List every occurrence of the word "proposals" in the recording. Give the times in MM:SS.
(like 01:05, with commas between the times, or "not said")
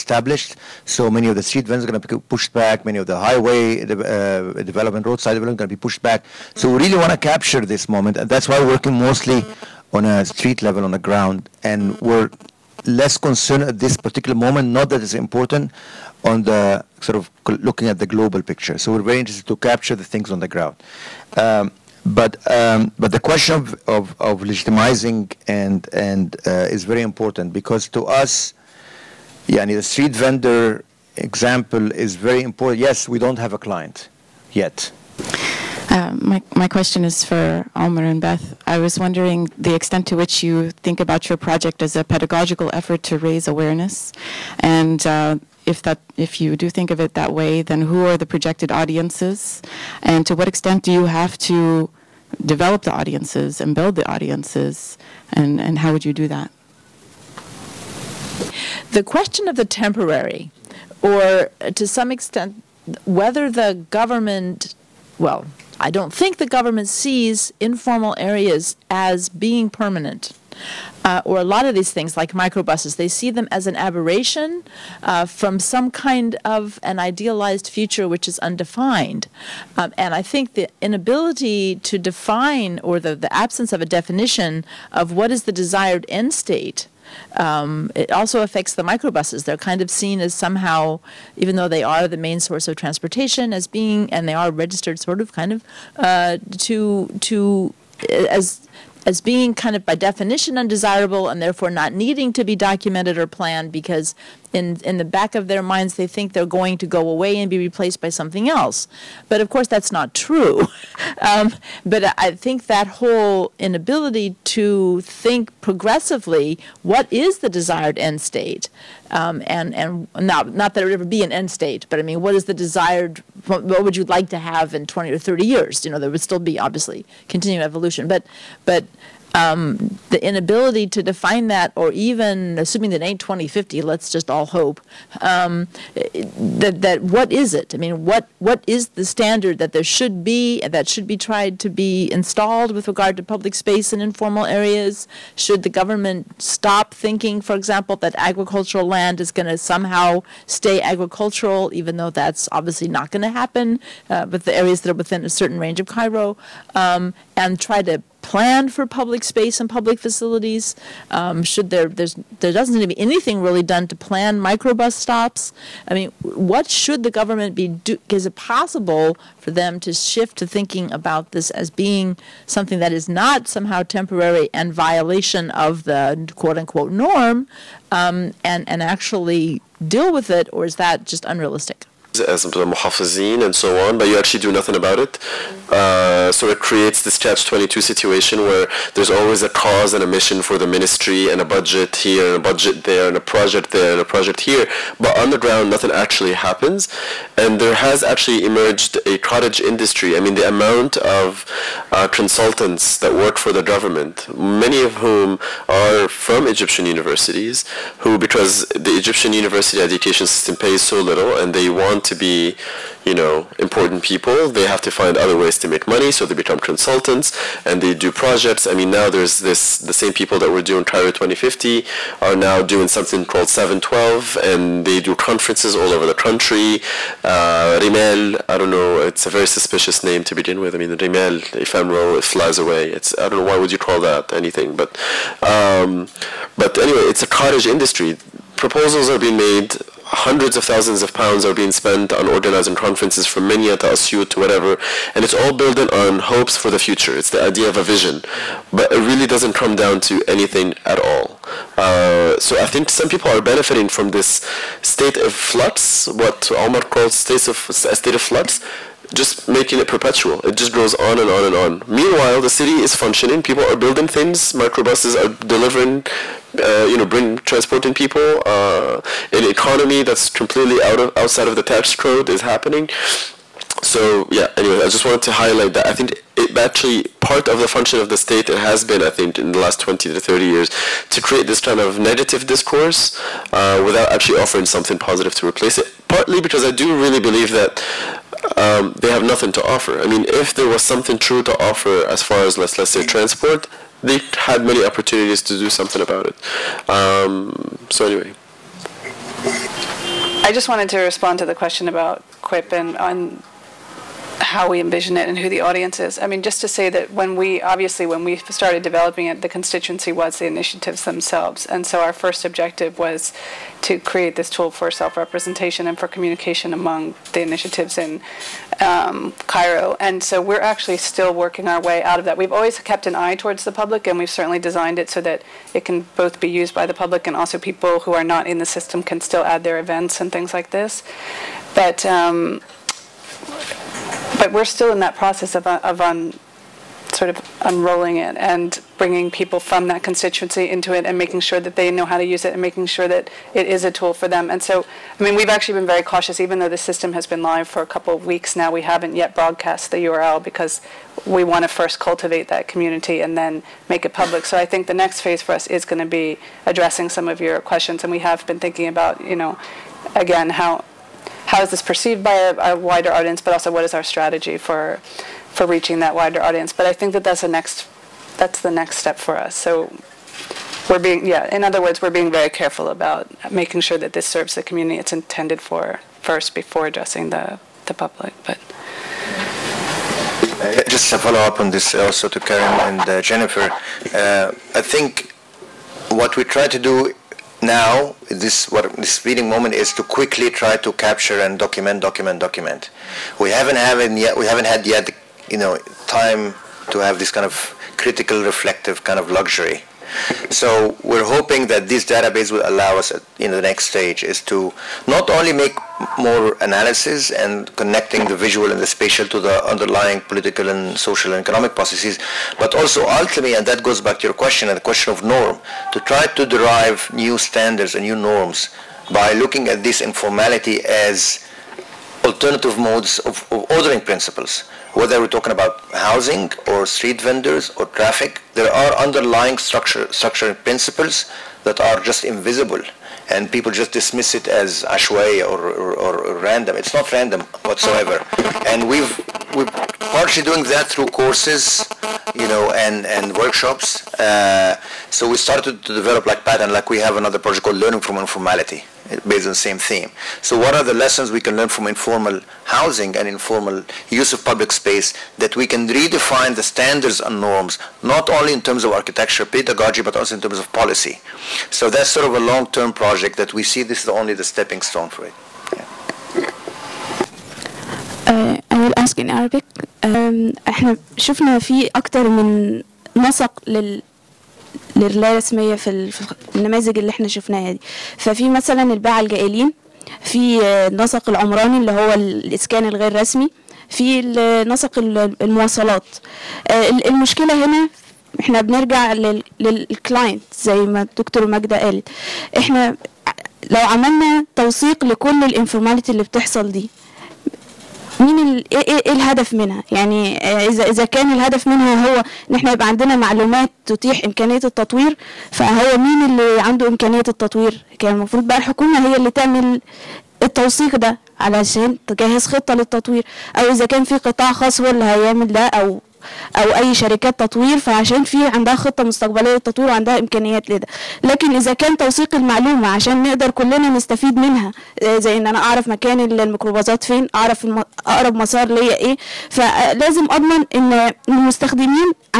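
03:58.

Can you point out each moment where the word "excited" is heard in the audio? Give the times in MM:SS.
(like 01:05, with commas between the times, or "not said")
not said.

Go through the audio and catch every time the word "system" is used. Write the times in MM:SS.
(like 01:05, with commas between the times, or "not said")
03:30, 05:28, 05:46.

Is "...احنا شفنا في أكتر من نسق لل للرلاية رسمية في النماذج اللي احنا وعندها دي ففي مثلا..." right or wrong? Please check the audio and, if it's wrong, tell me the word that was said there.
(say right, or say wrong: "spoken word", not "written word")
wrong: "شفناها", not "وعندها".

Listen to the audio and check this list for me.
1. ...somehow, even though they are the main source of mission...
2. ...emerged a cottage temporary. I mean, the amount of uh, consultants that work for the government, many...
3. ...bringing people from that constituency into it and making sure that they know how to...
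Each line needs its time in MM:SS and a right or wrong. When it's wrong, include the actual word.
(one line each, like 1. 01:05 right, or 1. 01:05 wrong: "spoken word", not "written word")
1. 01:30 wrong: "transportation", not "mission"
2. 03:18 wrong: "industry", not "temporary"
3. 05:38 right.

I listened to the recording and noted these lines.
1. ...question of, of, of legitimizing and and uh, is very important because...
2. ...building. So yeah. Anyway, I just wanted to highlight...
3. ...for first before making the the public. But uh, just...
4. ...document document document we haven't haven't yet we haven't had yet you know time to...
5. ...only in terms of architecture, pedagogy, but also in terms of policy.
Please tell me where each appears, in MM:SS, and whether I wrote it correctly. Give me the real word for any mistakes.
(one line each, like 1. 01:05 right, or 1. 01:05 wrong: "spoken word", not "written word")
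1. 00:23 right
2. 04:32 wrong: "happening", not "building"
3. 06:15 wrong: "addressing", not "making"
4. 06:31 right
5. 07:38 right.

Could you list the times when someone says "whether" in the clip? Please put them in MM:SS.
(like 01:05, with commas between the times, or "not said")
01:03, 07:04.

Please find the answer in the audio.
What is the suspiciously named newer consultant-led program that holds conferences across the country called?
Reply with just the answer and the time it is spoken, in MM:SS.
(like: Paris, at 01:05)
712, at 03:43.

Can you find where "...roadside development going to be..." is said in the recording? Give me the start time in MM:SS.
00:05.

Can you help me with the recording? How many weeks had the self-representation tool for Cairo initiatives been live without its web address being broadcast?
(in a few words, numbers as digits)
a couple of weeks.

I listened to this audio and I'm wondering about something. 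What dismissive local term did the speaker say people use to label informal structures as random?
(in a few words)
ashway.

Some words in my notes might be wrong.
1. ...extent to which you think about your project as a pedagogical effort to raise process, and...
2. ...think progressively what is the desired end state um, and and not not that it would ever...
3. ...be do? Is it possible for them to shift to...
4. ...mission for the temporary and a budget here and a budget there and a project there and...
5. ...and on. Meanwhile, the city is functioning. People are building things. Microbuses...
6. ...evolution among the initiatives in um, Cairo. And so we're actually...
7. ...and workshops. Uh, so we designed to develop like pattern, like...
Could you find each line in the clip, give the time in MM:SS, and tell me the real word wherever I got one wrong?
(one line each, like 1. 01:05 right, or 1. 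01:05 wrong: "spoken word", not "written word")
1. 00:39 wrong: "awareness", not "process"
2. 01:55 right
3. 02:47 right
4. 03:10 wrong: "ministry", not "temporary"
5. 04:21 right
6. 05:16 wrong: "communication", not "evolution"
7. 07:23 wrong: "started", not "designed".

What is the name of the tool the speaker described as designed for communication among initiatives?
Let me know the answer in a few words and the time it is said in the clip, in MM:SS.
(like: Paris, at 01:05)
Quip, at 05:02.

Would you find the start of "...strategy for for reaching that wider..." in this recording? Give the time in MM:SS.
06:04.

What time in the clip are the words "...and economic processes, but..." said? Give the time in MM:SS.
06:51.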